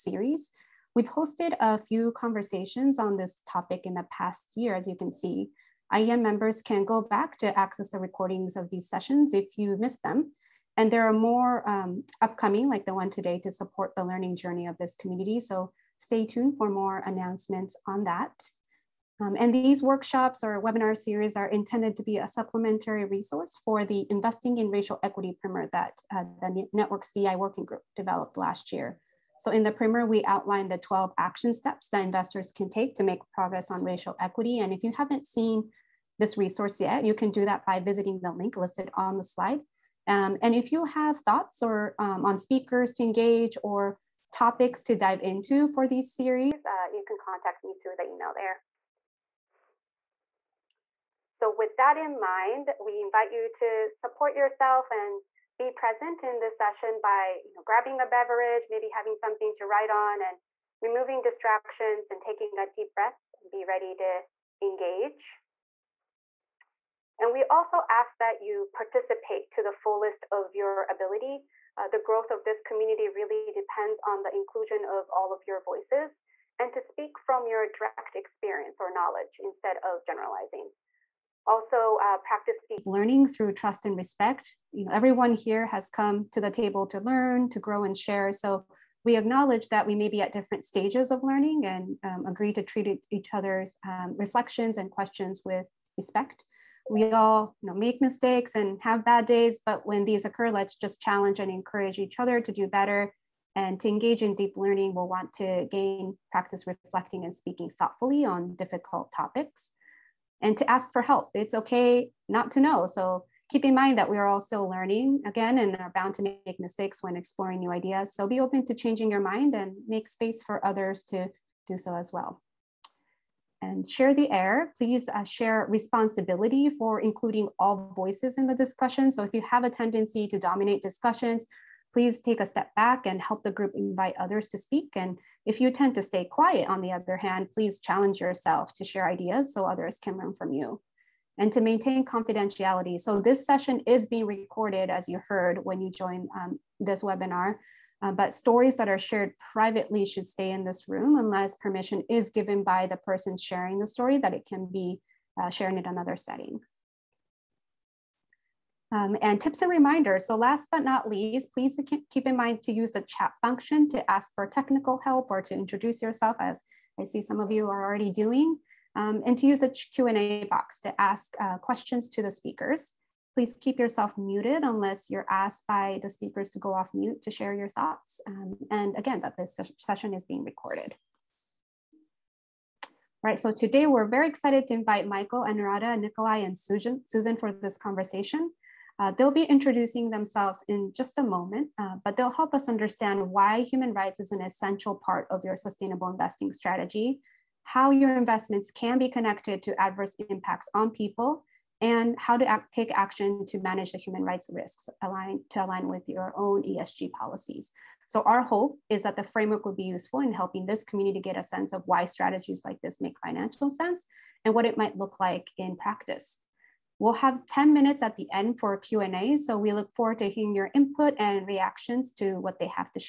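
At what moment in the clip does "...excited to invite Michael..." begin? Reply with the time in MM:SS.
03:04.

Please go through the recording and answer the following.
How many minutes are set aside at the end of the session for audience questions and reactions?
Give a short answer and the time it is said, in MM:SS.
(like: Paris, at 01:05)
10, at 03:37.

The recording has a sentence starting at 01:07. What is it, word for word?
And we also ask that you participate to the fullest of your ability.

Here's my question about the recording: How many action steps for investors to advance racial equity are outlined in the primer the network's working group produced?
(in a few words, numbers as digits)
12.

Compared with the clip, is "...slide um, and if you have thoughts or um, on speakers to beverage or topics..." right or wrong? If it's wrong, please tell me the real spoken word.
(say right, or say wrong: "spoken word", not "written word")
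wrong: "engage", not "beverage".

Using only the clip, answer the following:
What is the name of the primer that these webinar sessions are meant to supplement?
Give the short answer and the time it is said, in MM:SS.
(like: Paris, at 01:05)
Investing in Racial Equity Primer, at 00:24.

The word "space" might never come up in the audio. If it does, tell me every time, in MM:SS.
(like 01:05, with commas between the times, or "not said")
02:00.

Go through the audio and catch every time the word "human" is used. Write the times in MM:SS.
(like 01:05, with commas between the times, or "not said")
03:13, 03:23.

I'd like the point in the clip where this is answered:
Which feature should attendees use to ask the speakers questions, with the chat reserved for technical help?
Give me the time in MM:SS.
02:49.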